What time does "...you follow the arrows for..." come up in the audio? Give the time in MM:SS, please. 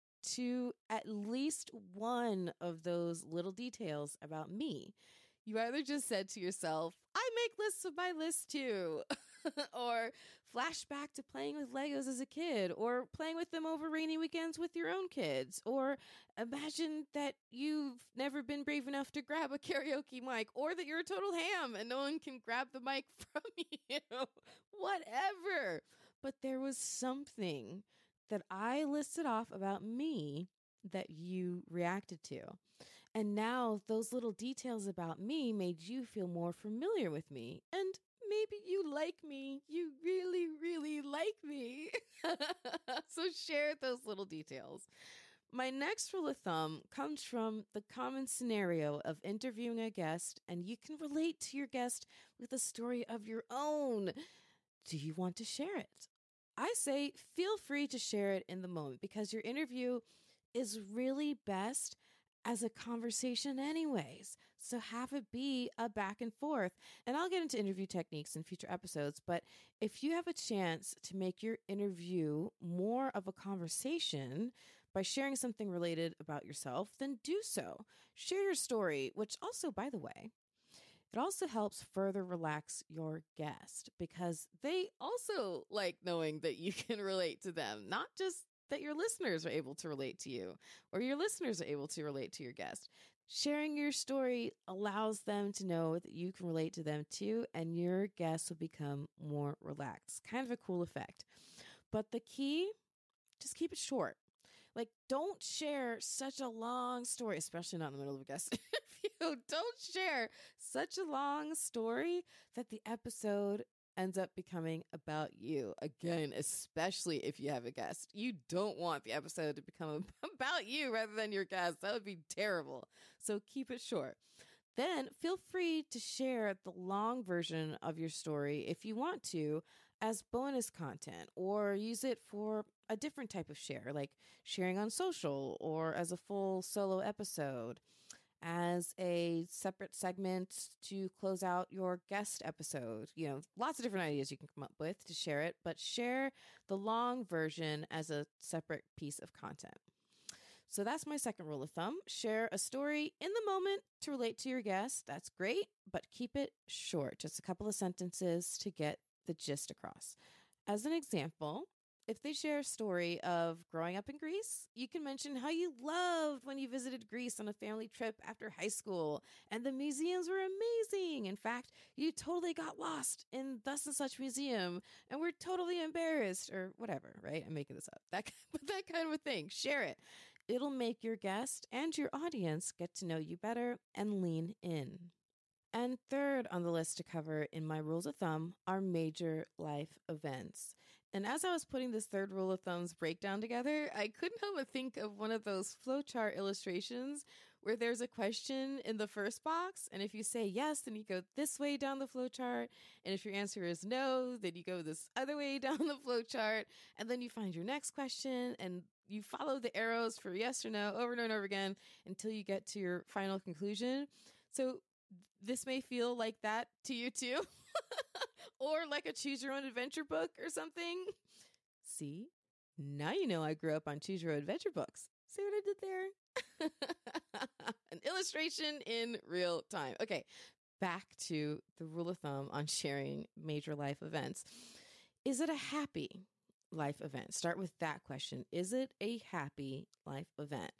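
03:29.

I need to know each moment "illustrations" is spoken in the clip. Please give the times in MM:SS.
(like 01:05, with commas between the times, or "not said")
03:16, 03:48.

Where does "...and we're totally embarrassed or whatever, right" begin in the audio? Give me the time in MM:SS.
02:55.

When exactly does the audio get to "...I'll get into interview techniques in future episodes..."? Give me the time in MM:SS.
01:07.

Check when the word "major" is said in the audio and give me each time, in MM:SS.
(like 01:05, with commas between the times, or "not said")
03:08, 03:53.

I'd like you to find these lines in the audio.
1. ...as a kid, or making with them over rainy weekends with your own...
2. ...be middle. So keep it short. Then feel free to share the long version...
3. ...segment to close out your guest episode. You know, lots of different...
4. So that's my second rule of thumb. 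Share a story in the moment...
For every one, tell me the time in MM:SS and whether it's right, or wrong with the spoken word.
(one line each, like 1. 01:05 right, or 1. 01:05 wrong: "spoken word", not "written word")
1. 00:12 wrong: "playing", not "making"
2. 02:02 wrong: "terrible", not "middle"
3. 02:19 right
4. 02:30 right.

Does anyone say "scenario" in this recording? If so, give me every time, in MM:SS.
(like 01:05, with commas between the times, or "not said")
00:48.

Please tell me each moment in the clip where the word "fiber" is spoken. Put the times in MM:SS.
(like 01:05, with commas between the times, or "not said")
not said.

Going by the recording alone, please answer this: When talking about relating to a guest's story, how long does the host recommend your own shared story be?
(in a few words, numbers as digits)
a couple of sentences.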